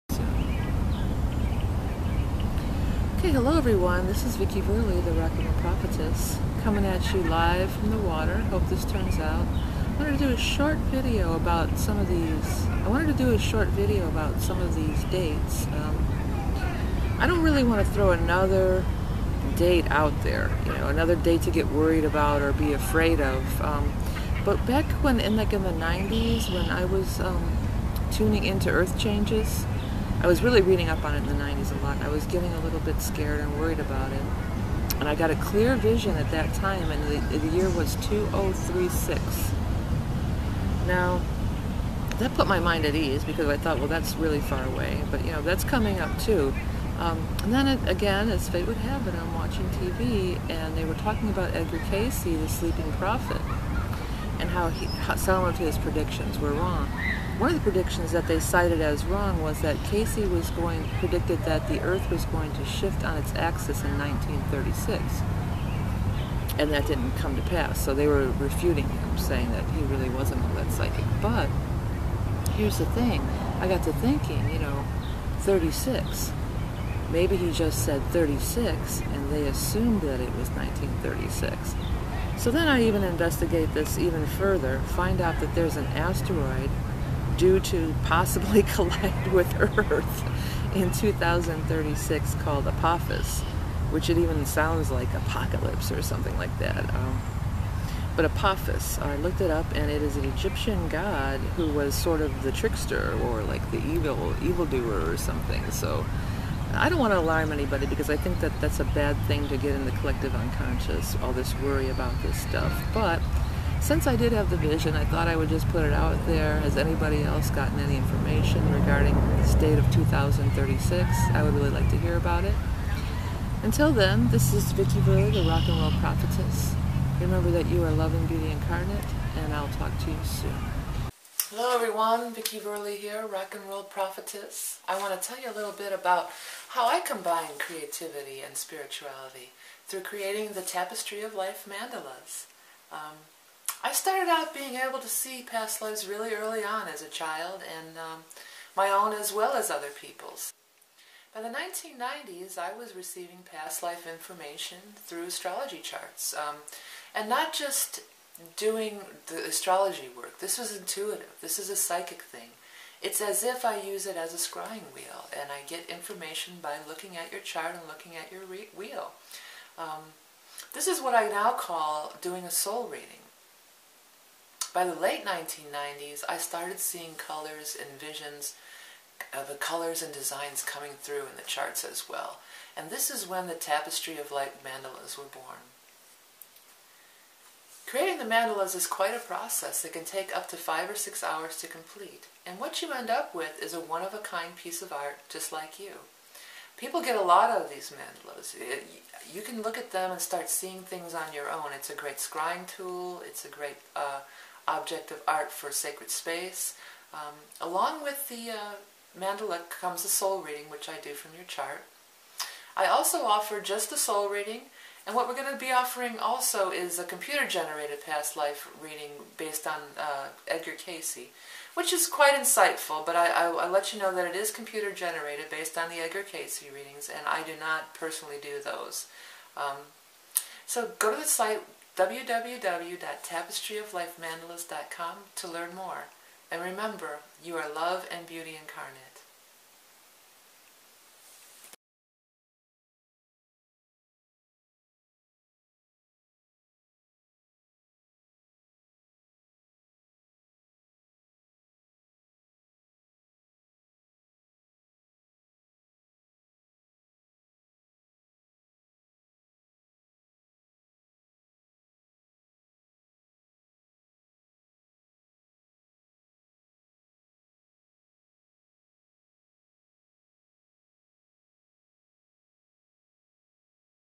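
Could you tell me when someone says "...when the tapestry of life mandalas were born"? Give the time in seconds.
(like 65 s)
183 s.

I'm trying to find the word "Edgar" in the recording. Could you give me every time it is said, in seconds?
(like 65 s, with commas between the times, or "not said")
51 s, 220 s, 225 s.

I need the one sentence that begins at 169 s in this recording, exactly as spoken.
Um, this is what I now call doing a soul reading.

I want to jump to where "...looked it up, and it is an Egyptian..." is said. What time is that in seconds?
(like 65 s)
99 s.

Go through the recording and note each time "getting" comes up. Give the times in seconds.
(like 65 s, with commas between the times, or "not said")
32 s.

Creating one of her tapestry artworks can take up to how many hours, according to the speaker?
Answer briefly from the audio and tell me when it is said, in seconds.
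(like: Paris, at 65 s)
5 or 6 hours, at 190 s.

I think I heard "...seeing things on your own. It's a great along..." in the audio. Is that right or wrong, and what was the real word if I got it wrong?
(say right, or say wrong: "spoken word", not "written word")
wrong: "scrying", not "along".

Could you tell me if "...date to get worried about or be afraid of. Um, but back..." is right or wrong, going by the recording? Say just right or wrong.
right.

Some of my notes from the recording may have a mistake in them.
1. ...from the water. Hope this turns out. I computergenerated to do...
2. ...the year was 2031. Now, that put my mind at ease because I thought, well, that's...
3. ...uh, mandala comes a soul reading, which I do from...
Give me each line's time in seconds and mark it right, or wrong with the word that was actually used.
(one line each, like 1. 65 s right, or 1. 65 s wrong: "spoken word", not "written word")
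1. 7 s wrong: "wanted", not "computergenerated"
2. 37 s wrong: "2036", not "2031"
3. 208 s right.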